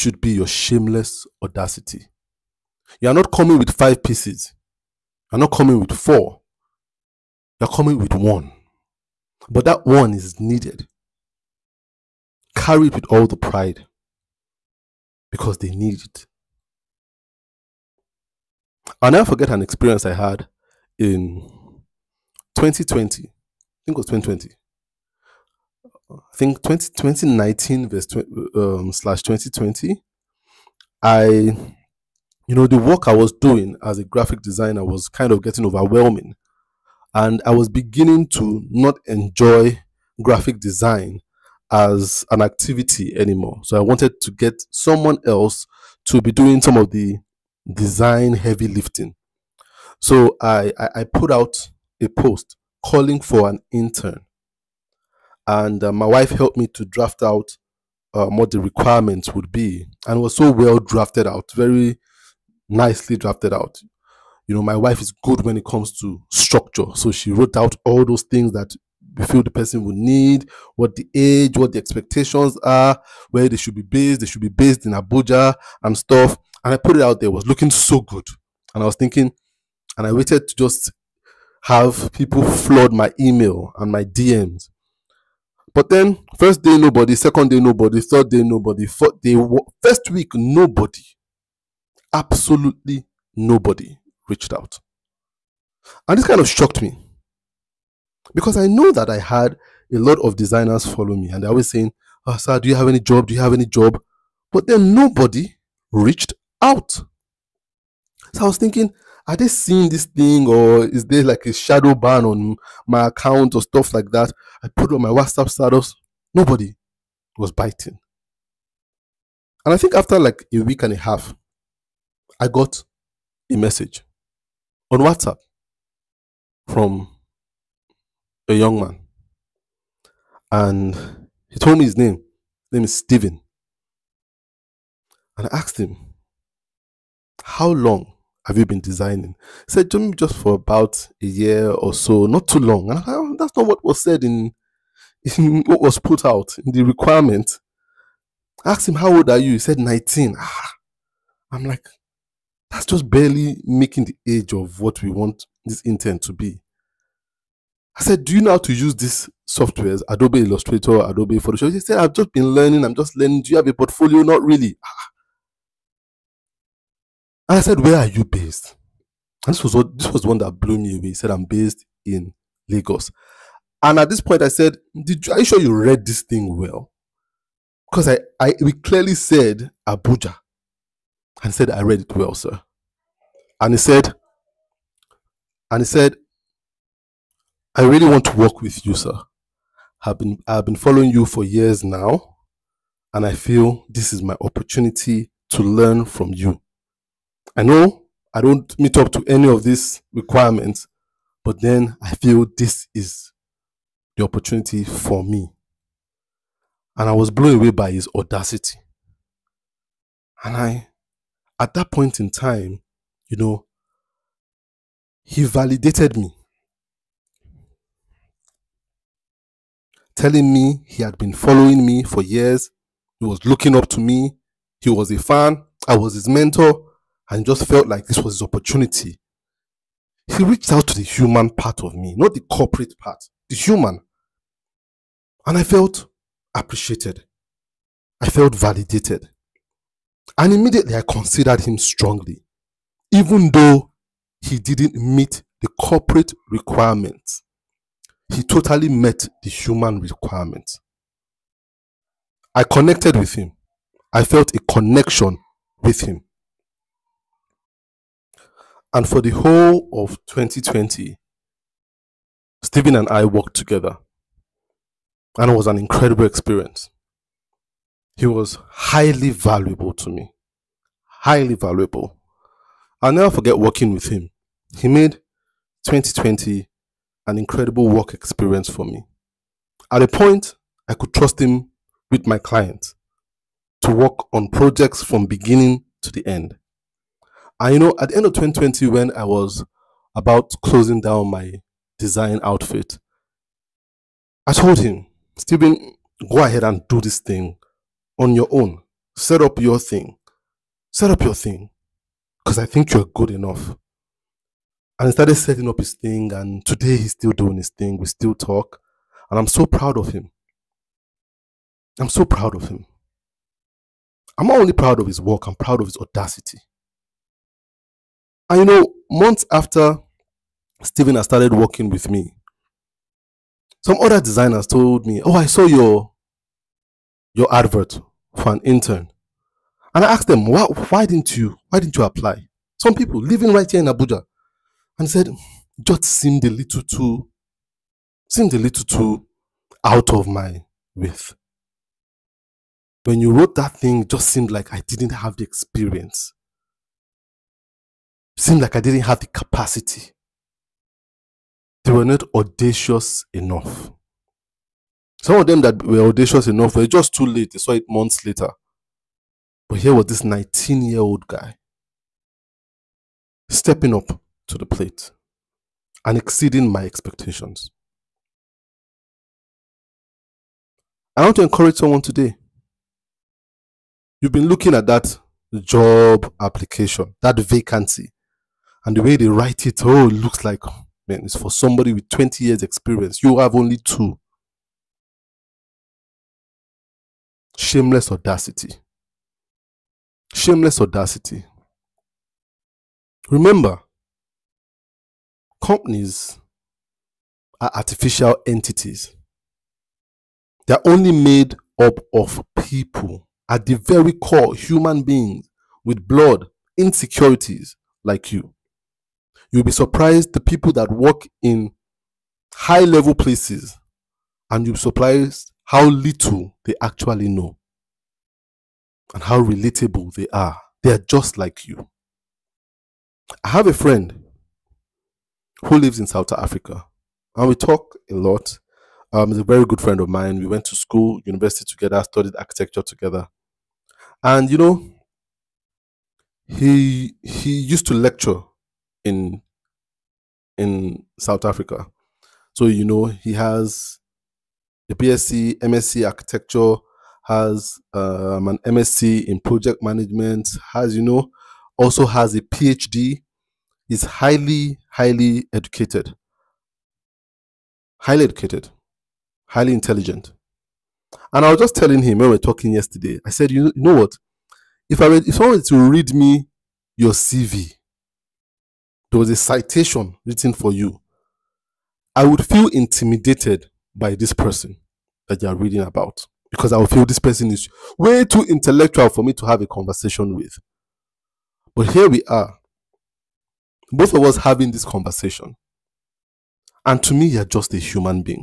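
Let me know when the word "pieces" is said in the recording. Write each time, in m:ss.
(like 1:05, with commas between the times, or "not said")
0:04.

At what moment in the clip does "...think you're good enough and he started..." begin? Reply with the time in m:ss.
5:02.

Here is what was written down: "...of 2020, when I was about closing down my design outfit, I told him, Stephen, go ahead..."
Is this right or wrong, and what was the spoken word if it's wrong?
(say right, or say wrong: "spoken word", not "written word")
right.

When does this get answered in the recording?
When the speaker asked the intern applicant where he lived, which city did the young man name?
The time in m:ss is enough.
2:51.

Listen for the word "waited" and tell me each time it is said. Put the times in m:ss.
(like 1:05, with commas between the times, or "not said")
1:20.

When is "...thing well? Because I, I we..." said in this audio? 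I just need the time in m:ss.
2:56.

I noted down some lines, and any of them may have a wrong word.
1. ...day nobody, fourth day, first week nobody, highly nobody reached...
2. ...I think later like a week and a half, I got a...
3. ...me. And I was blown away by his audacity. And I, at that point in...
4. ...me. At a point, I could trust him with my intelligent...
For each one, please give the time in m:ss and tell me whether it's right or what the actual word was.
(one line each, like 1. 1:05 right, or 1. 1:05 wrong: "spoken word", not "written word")
1. 1:28 wrong: "absolutely", not "highly"
2. 1:59 wrong: "after", not "later"
3. 3:25 right
4. 4:38 wrong: "client", not "intelligent".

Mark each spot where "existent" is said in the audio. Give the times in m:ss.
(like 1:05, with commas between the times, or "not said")
not said.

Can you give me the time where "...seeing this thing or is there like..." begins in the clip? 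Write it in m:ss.
1:49.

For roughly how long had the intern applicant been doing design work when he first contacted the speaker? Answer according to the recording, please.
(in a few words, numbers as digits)
about a year.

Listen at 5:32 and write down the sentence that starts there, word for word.
Some people living right here in Abuja, and said, Just seemed a little too, seemed a little too out of my width.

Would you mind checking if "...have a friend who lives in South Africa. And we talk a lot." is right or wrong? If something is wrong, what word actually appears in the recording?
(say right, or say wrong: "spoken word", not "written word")
right.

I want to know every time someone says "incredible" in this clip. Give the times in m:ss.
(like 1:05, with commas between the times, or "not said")
4:25, 4:37.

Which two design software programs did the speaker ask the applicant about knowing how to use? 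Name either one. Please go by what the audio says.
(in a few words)
Adobe Illustrator.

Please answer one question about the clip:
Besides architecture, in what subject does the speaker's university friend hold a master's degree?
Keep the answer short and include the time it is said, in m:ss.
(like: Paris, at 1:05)
project management, at 7:29.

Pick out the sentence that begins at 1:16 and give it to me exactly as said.
And I put it out there, it was looking so good.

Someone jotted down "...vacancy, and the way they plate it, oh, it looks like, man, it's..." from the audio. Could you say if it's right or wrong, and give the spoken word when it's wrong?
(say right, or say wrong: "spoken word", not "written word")
wrong: "write", not "plate".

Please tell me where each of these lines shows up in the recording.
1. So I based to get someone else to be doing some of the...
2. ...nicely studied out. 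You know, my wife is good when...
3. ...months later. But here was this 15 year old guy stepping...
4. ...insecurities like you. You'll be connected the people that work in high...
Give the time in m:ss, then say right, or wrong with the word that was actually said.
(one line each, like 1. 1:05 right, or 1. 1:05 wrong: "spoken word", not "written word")
1. 0:43 wrong: "wanted", not "based"
2. 1:02 wrong: "drafted", not "studied"
3. 5:57 wrong: "19", not "15"
4. 6:46 wrong: "surprised", not "connected".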